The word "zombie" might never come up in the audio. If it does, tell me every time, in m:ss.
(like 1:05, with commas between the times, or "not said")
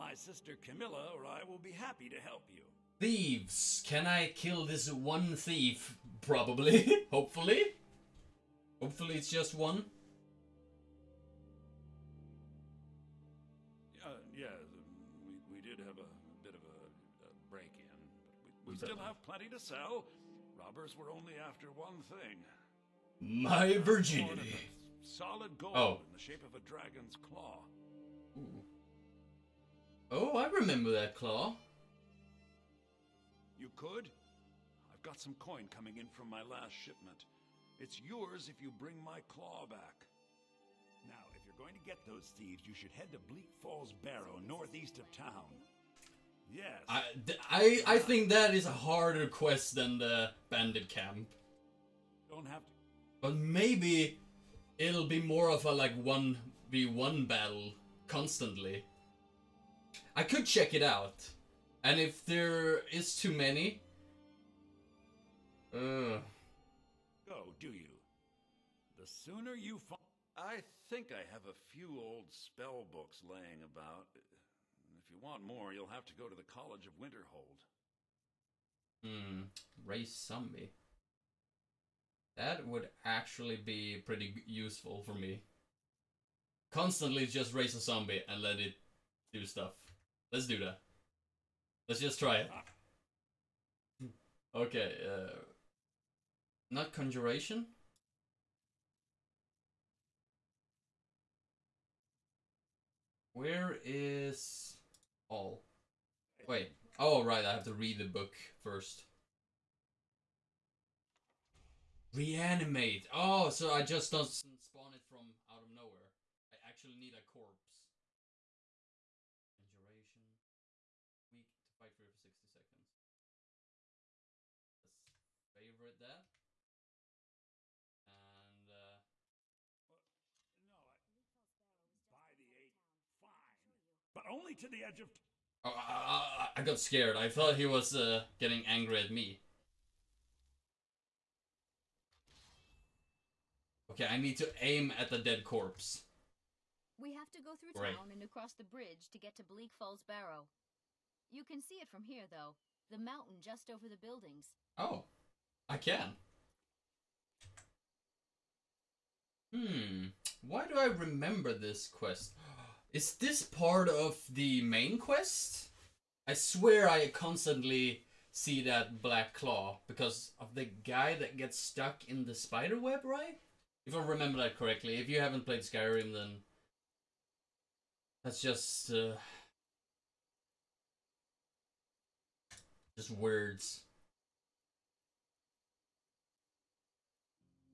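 1:20, 1:27.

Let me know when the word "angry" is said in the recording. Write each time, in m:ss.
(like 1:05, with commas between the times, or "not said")
2:18.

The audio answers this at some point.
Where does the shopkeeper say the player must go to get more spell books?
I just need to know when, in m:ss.
1:16.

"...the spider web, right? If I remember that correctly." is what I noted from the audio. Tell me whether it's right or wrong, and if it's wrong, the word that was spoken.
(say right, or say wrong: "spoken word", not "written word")
right.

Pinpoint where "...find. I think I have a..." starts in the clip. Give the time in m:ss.
1:09.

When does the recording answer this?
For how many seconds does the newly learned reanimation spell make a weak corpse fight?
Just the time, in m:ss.
2:02.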